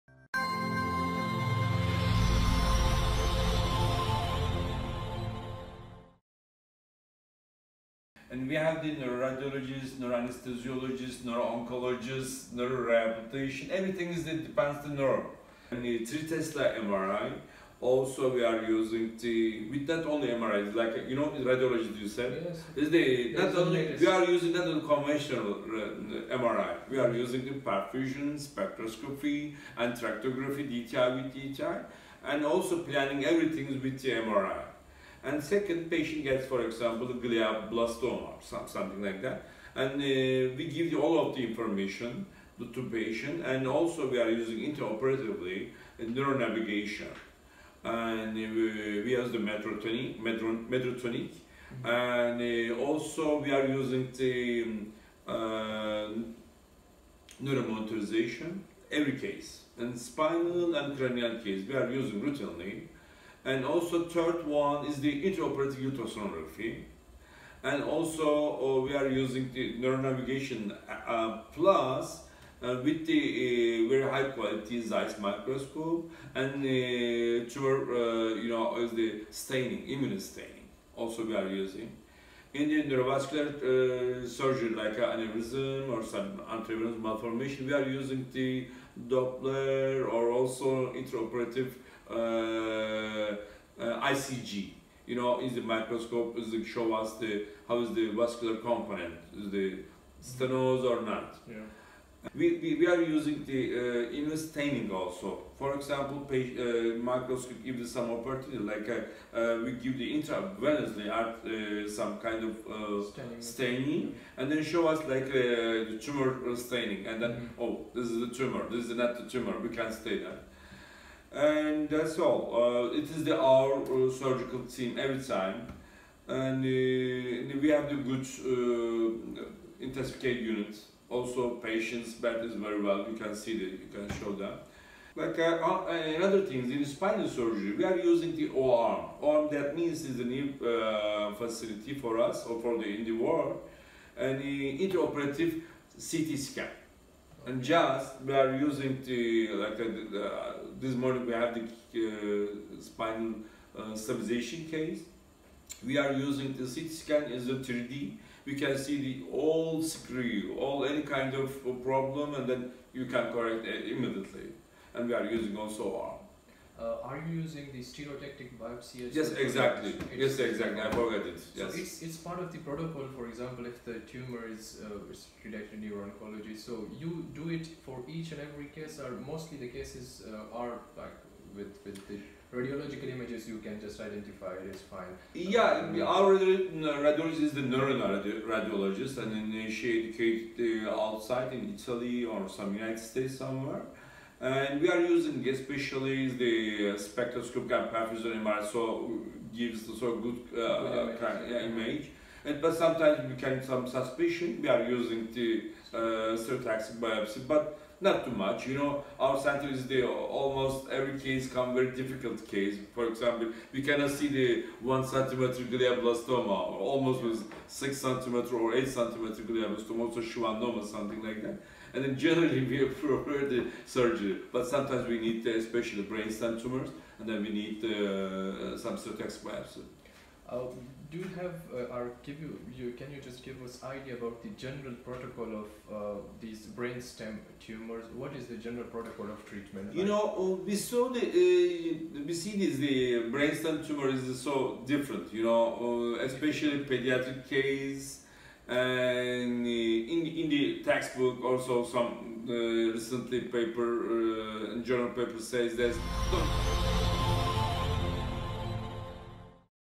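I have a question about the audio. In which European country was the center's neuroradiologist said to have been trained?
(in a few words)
Italy.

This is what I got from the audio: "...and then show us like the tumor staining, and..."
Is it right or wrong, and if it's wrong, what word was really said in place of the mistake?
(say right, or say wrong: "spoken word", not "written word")
right.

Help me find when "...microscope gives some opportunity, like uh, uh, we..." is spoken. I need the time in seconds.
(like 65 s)
107 s.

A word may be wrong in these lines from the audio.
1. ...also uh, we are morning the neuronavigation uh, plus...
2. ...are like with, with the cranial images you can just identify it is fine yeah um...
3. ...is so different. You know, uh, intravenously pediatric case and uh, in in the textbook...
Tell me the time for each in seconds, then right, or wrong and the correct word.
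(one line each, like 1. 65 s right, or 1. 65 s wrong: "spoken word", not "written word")
1. 67 s wrong: "using", not "morning"
2. 180 s wrong: "radiological", not "cranial"
3. 244 s wrong: "especially", not "intravenously".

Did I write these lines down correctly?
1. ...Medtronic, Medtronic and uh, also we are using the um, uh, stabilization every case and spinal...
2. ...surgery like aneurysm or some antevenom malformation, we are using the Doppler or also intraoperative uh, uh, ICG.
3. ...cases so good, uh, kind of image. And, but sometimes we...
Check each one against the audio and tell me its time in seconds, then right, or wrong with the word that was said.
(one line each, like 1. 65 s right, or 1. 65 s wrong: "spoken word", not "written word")
1. 49 s wrong: "neuromonitorization", not "stabilization"
2. 84 s right
3. 199 s wrong: "gives", not "cases".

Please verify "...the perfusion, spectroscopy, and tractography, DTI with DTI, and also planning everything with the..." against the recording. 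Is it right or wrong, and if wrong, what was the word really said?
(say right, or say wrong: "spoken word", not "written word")
right.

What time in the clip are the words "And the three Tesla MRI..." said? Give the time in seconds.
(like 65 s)
15 s.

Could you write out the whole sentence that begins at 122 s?
Uh, it is the, our uh, surgical team every time, and uh, we have the good care unit.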